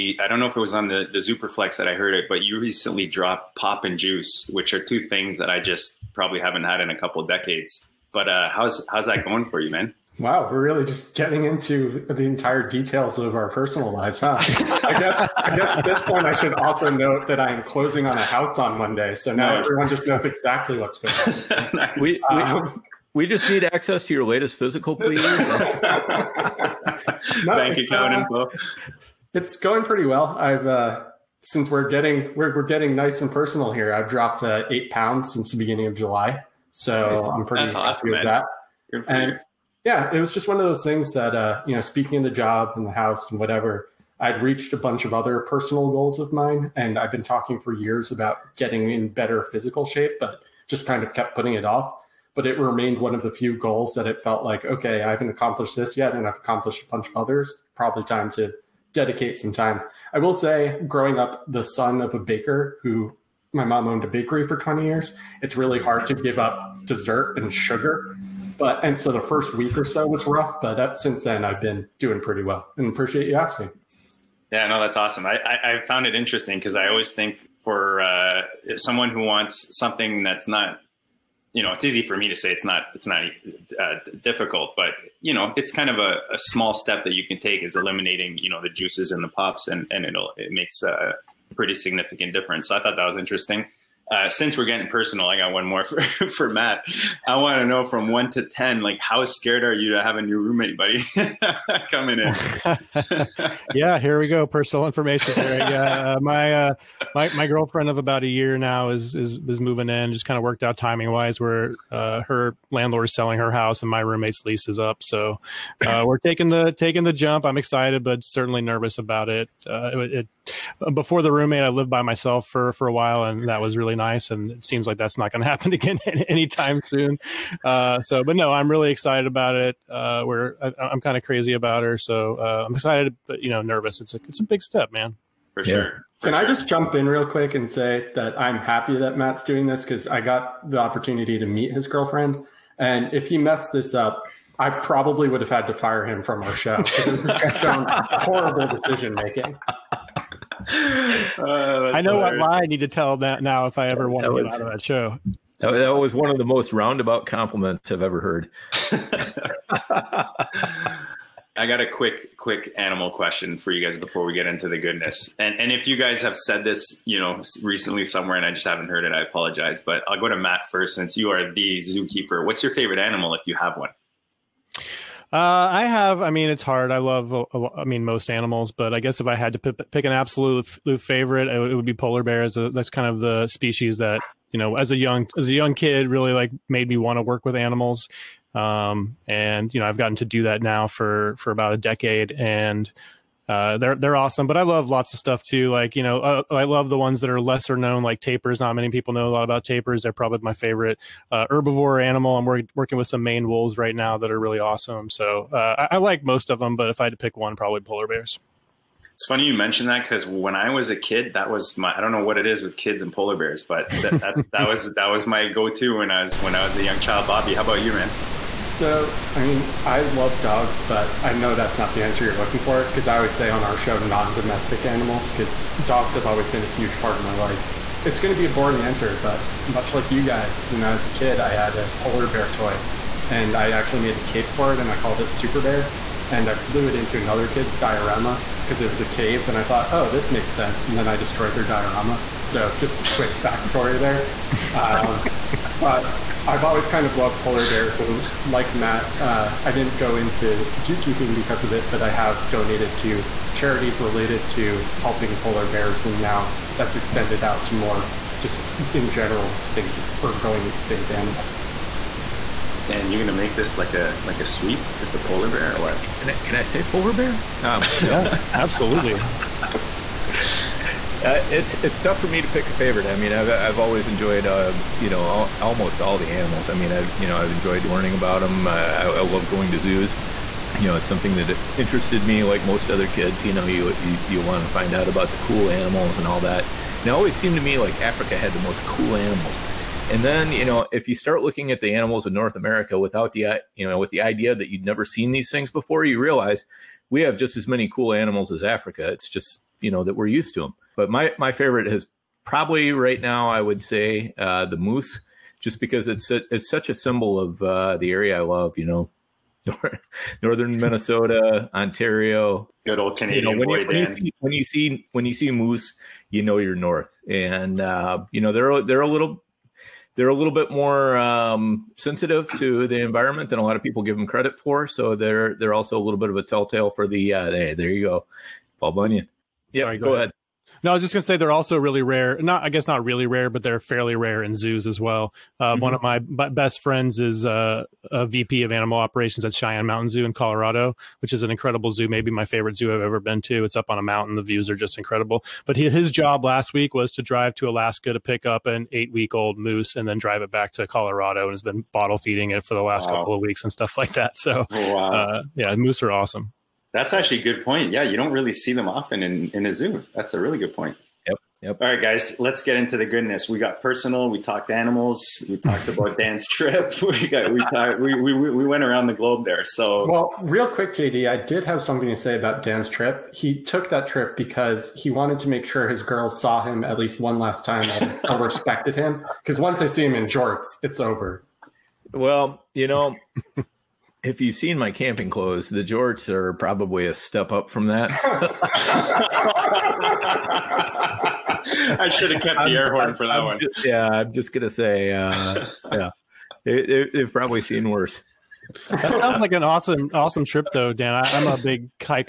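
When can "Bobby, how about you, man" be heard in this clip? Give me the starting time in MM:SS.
03:37.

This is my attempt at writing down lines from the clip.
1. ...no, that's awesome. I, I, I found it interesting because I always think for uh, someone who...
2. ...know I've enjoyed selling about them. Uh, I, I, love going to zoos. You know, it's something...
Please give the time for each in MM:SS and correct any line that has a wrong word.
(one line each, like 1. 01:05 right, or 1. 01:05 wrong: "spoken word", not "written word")
1. 01:14 right
2. 04:37 wrong: "learning", not "selling".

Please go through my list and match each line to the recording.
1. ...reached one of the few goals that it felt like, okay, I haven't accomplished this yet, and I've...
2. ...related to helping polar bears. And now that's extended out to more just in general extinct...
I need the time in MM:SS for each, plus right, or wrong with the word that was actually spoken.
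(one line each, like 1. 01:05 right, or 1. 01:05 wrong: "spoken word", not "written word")
1. 00:52 wrong: "remained", not "reached"
2. 04:13 right.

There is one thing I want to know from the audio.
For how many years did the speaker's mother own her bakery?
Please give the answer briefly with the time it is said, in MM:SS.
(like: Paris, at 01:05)
20 years, at 01:04.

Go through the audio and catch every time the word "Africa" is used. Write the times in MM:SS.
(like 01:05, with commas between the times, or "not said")
04:48, 04:58.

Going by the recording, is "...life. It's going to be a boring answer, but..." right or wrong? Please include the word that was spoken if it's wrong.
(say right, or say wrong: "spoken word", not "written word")
right.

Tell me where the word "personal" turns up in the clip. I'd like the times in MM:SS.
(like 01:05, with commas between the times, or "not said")
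00:13, 00:33, 00:45, 01:34, 01:44, 06:03.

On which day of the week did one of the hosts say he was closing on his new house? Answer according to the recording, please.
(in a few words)
Monday.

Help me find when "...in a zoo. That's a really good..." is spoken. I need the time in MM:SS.
05:59.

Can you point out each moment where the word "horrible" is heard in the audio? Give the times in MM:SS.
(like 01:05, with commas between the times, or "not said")
02:26.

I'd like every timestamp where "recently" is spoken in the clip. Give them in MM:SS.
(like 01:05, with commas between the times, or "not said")
00:02, 02:47.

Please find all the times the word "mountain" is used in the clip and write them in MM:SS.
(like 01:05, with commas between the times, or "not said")
05:39, 05:44.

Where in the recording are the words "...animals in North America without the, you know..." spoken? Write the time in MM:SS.
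04:51.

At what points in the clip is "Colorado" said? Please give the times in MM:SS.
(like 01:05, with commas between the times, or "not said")
05:40, 05:50.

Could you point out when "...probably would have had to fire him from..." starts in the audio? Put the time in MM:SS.
02:24.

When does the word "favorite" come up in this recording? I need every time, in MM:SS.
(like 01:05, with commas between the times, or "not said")
02:52, 03:00, 03:20, 04:32, 05:01, 05:42.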